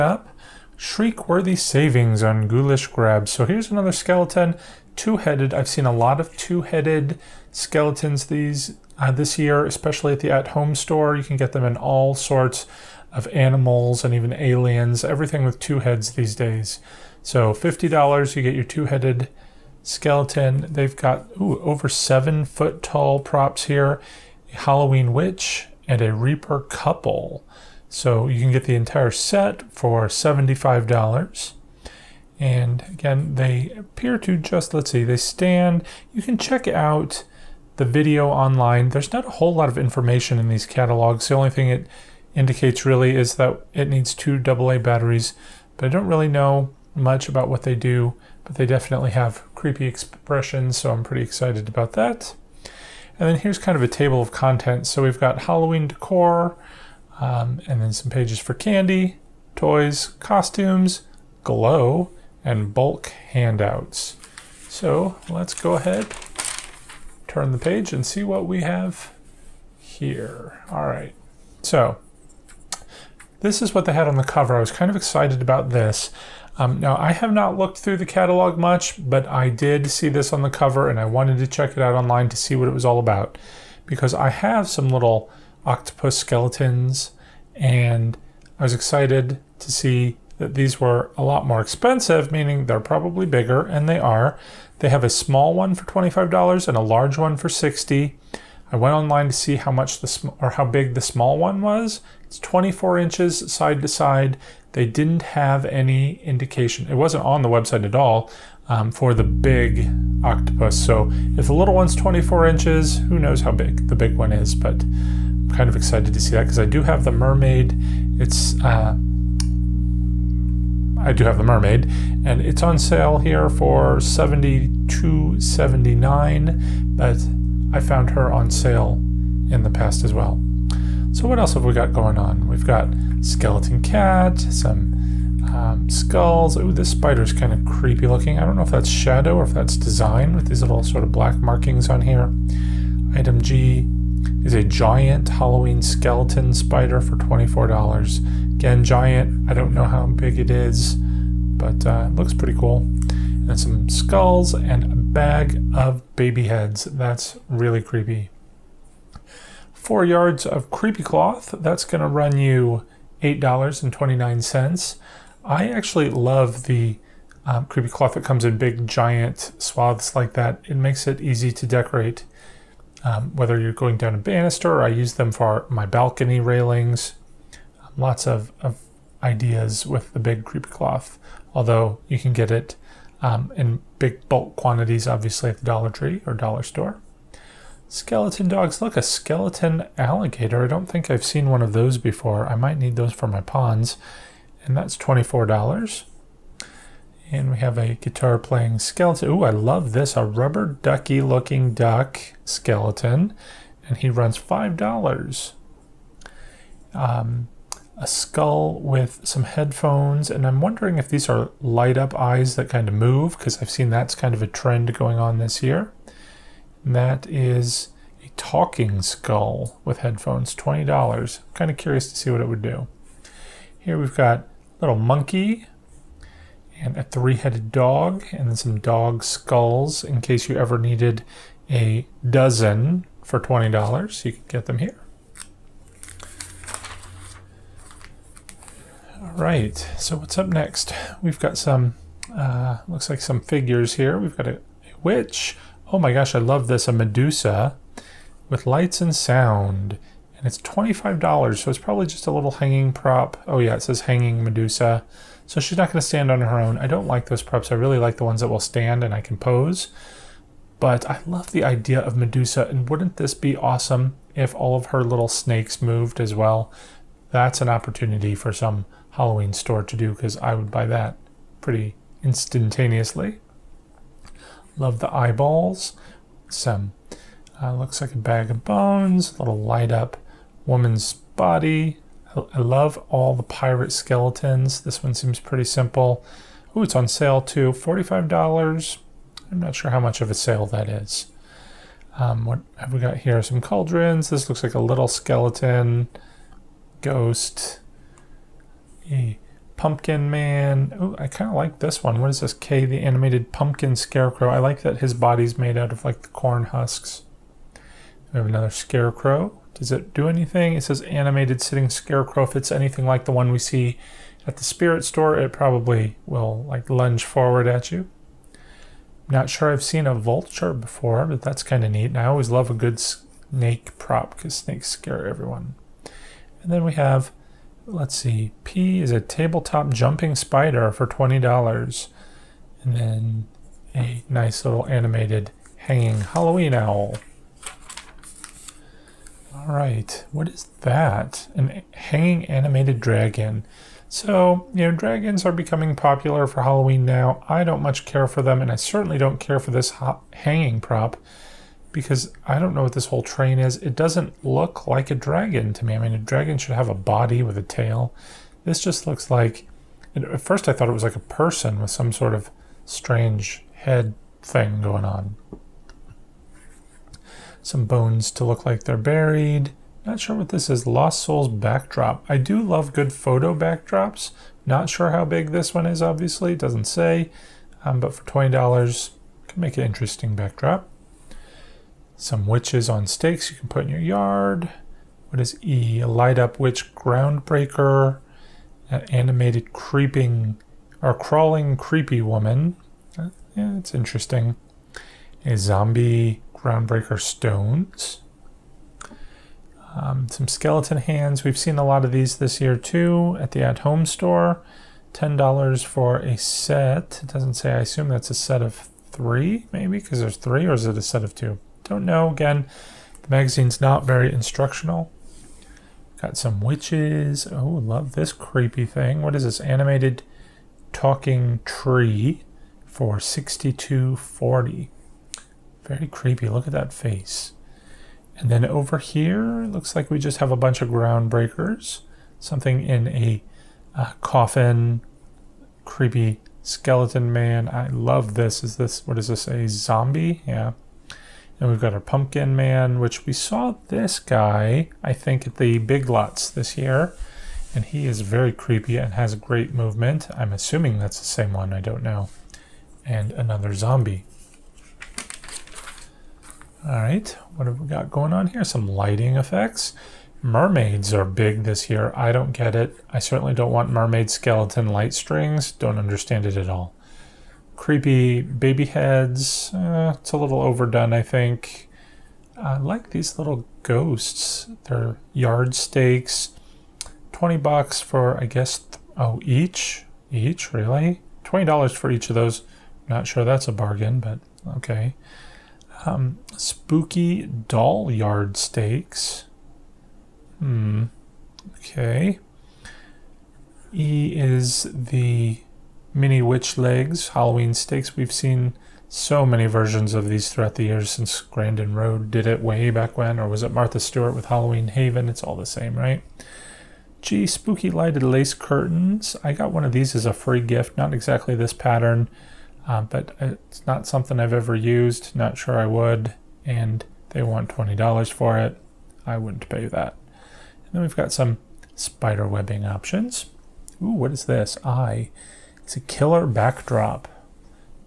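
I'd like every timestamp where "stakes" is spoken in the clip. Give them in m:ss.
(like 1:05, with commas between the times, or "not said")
6:23, 7:55, 8:08, 8:17.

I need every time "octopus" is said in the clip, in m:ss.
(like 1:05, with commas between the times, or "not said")
1:25, 1:50.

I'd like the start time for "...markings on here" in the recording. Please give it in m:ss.
2:21.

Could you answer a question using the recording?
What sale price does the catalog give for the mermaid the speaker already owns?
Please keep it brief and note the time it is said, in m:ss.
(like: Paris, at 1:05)
$72.79, at 2:03.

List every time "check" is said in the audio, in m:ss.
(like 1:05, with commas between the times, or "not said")
0:36, 1:21.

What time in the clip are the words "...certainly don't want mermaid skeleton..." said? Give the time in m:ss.
7:43.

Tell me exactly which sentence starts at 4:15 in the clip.
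So she's not going to stand on her own.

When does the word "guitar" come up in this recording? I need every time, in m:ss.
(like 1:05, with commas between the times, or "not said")
3:17.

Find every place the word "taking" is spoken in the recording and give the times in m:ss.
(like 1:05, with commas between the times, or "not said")
not said.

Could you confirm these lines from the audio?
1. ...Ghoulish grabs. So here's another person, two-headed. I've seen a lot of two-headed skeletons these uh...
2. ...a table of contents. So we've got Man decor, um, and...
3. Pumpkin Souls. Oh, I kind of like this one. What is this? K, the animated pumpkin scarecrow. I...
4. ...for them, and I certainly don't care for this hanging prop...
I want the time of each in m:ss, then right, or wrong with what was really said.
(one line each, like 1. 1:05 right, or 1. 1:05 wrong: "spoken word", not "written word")
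1. 0:02 wrong: "skeleton", not "person"
2. 0:53 wrong: "Halloween", not "Man"
3. 4:59 wrong: "Man", not "Souls"
4. 5:48 right.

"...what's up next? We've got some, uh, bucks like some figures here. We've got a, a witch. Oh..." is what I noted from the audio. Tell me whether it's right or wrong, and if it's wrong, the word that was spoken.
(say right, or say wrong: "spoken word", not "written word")
wrong: "looks", not "bucks".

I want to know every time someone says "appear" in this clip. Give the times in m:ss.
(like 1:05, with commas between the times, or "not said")
0:33.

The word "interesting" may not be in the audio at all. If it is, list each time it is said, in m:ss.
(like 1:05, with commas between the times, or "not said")
6:19, 6:33.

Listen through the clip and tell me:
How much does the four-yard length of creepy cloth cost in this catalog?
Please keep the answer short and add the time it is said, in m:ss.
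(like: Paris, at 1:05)
$8.29, at 2:43.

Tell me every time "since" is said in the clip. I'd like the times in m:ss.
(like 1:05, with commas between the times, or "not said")
8:21.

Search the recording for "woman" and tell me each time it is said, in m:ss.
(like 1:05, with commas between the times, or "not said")
4:40, 6:32.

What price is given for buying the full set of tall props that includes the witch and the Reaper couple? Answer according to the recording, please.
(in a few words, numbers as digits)
$75.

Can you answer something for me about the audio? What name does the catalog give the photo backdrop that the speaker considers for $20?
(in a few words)
Lost Souls.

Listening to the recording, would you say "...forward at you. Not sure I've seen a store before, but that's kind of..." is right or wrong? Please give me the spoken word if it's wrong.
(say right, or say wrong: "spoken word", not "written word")
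wrong: "vulture", not "store".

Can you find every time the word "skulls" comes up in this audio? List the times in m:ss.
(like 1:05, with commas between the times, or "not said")
2:15, 2:33, 3:28, 3:39, 3:49.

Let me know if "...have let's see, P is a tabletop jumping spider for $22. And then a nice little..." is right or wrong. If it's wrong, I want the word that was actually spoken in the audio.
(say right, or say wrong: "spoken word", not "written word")
wrong: "20", not "22".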